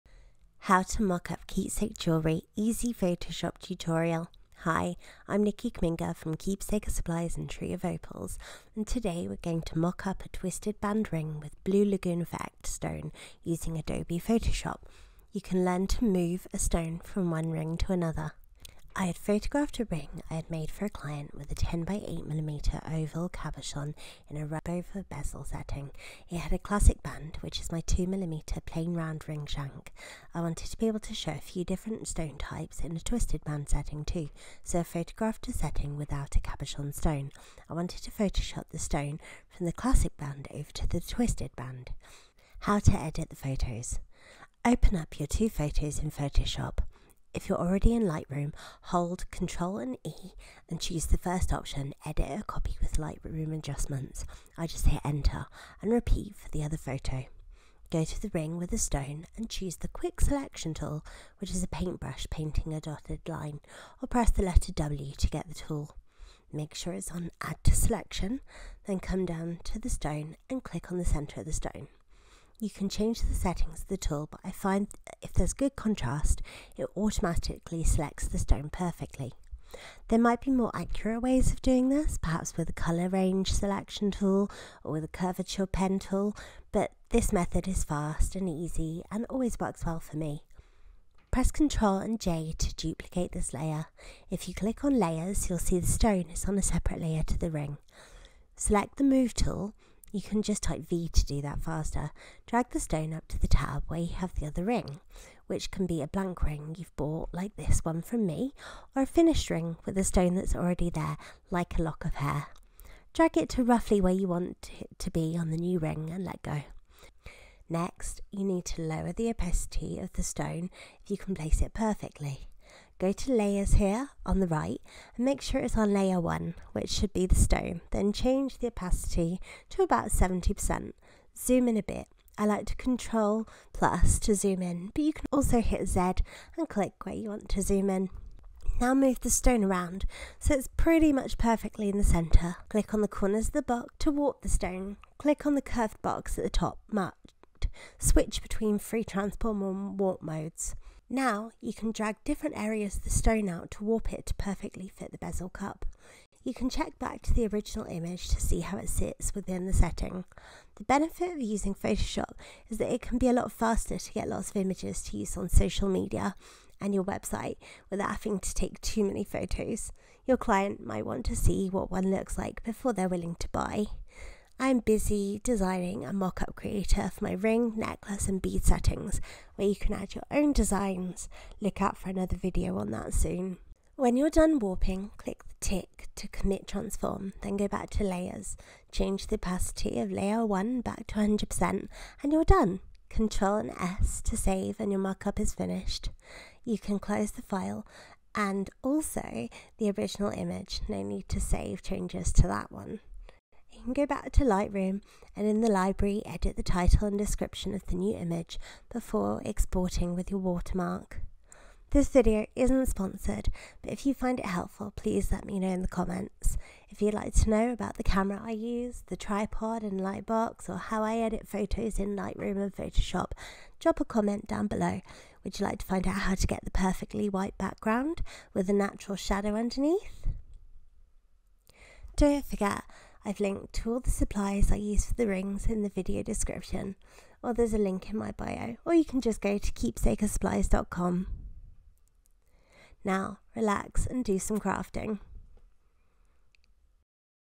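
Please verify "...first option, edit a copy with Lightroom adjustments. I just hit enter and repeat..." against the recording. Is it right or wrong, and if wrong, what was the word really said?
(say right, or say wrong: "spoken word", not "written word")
right.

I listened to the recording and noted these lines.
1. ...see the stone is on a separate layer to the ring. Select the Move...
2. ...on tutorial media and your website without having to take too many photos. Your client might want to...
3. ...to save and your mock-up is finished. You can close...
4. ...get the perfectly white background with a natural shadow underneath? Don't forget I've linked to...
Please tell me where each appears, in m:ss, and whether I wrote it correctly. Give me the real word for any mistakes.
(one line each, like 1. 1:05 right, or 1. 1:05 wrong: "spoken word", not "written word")
1. 1:35 right
2. 2:45 wrong: "social", not "tutorial"
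3. 3:14 right
4. 3:46 right.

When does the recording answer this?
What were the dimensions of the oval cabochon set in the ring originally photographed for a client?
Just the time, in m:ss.
0:21.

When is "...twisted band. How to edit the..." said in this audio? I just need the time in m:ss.
0:40.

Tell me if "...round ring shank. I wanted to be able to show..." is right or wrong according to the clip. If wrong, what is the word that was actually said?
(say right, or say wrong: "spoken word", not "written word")
right.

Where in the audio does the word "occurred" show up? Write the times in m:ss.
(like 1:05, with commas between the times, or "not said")
not said.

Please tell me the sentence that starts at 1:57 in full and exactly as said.
Next, you need to lower the opacity of the stone if you can place it perfectly.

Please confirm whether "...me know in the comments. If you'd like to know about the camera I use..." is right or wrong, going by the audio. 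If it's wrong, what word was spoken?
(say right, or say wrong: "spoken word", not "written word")
right.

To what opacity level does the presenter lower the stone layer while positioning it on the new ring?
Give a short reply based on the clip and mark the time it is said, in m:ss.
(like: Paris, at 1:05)
70%, at 2:10.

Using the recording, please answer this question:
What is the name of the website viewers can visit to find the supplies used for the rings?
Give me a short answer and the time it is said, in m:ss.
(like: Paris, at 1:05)
keepsakersupplies.com, at 3:59.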